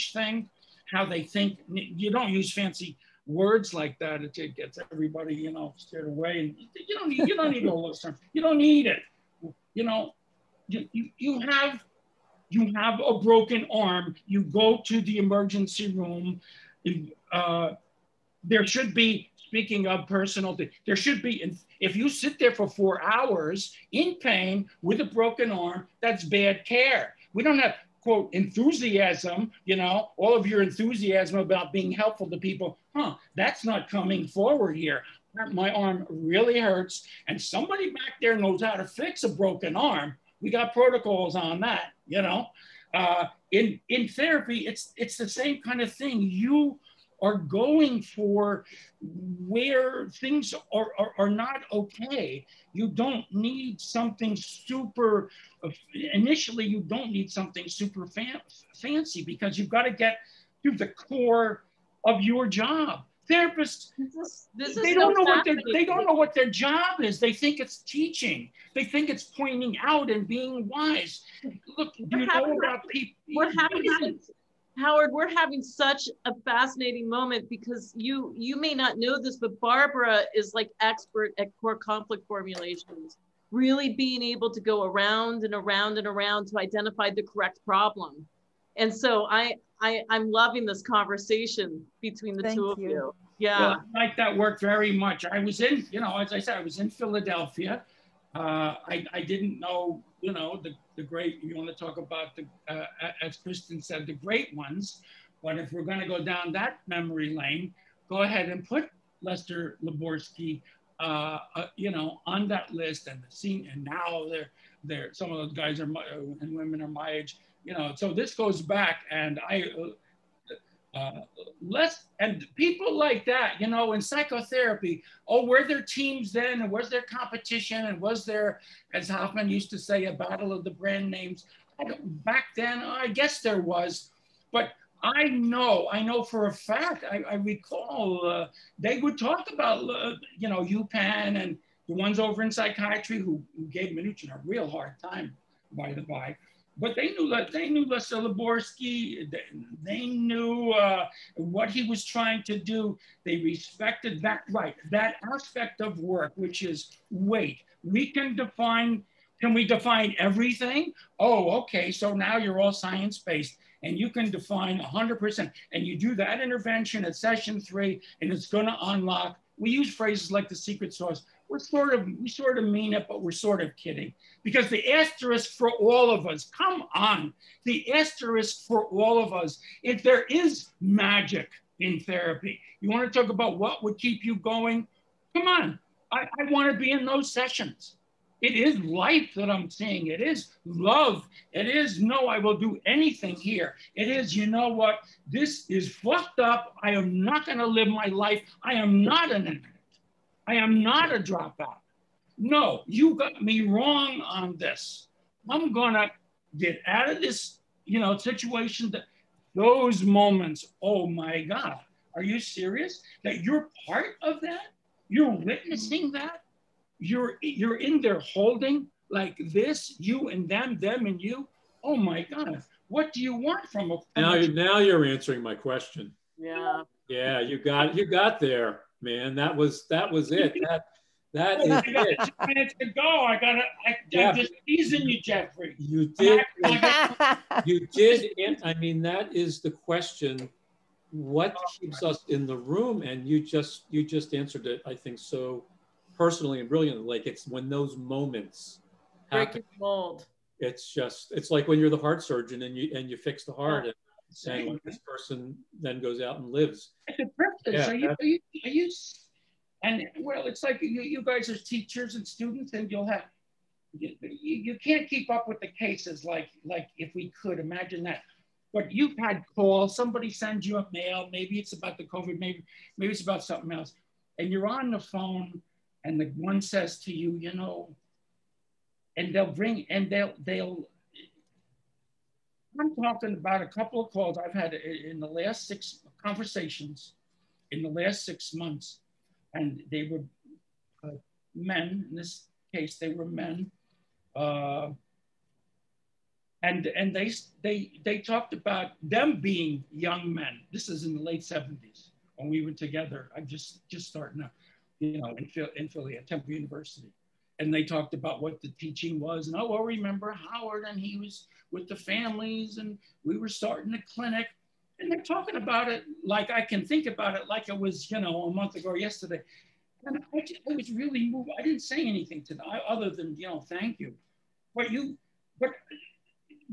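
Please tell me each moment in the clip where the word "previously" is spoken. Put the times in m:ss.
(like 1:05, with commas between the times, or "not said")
not said.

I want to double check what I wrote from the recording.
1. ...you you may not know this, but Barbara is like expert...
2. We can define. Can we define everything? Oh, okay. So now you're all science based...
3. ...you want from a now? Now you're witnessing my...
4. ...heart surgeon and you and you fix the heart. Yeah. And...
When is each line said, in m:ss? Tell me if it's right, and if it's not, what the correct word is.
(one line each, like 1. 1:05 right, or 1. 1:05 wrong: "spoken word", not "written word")
1. 1:17 right
2. 2:37 right
3. 3:43 wrong: "answering", not "witnessing"
4. 4:11 right.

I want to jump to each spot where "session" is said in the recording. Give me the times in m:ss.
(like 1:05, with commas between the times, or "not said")
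2:47, 3:07.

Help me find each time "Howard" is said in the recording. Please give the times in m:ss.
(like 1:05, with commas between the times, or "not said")
1:14, 5:10.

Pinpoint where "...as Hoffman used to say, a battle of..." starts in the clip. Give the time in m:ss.
2:08.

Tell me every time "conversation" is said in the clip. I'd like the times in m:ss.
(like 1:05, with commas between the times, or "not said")
1:30, 4:46.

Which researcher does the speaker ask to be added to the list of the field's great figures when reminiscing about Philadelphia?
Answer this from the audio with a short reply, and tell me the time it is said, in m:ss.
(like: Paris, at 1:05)
Lester Luborsky, at 1:49.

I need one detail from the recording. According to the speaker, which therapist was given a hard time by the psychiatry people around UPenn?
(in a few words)
Minuchin.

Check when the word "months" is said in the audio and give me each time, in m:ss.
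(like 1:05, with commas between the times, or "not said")
4:48, 5:18.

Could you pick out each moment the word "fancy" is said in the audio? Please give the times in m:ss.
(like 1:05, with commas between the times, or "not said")
0:02, 0:58.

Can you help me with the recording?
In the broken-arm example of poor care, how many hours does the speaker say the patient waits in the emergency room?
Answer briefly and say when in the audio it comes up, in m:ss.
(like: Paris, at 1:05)
4, at 0:22.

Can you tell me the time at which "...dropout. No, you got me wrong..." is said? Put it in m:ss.
3:21.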